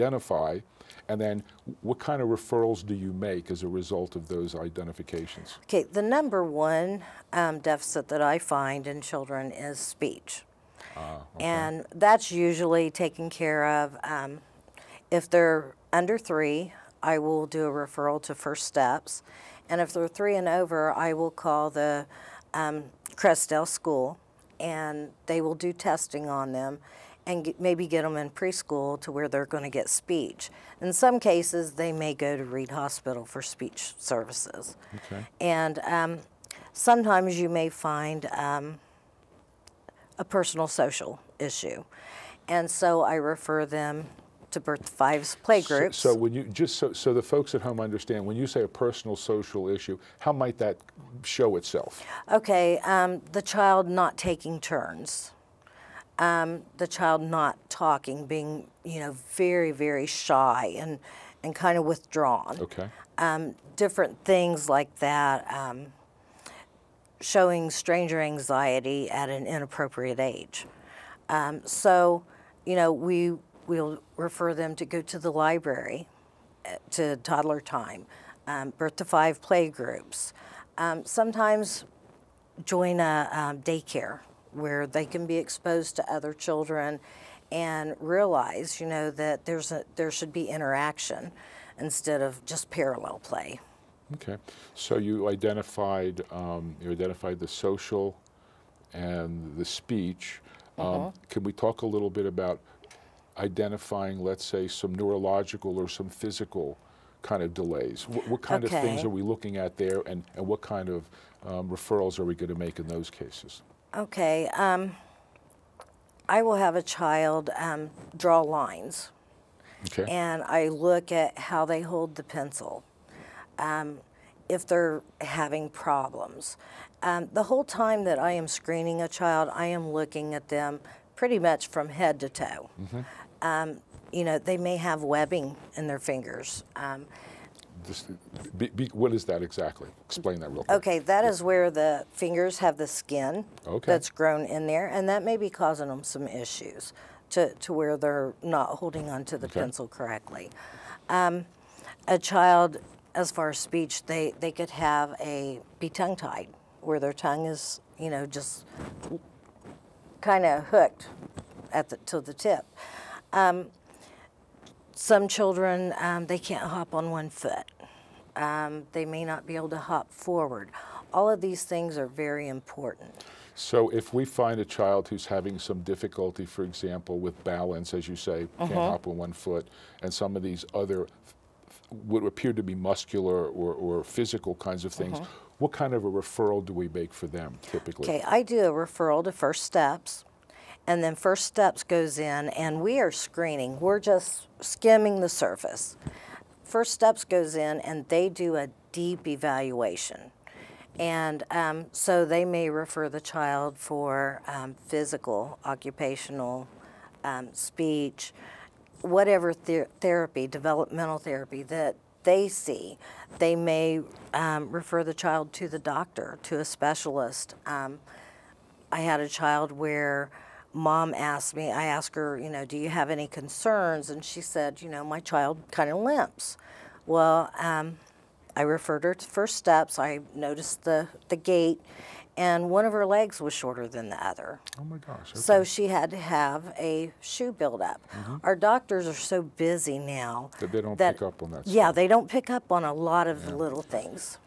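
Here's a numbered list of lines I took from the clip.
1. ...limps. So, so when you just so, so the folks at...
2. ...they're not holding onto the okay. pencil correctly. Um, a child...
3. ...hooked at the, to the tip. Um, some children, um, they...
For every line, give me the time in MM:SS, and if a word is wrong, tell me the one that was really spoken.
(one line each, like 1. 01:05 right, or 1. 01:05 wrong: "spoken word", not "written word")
1. 00:45 wrong: "playgroups", not "limps"
2. 02:27 right
3. 02:40 right.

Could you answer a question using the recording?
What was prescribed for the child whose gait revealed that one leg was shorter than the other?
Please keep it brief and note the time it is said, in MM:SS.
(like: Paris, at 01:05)
shoe buildup, at 03:57.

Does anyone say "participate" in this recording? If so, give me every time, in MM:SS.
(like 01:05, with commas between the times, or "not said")
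not said.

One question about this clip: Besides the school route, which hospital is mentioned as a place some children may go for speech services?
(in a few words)
Reid Hospital.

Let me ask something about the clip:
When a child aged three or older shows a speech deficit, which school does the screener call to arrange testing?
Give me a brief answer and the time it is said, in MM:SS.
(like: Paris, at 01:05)
Crestdale School, at 00:23.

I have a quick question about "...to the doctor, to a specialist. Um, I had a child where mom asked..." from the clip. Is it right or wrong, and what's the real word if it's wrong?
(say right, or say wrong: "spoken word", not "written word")
right.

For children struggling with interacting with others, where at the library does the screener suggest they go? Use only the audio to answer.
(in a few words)
toddler time.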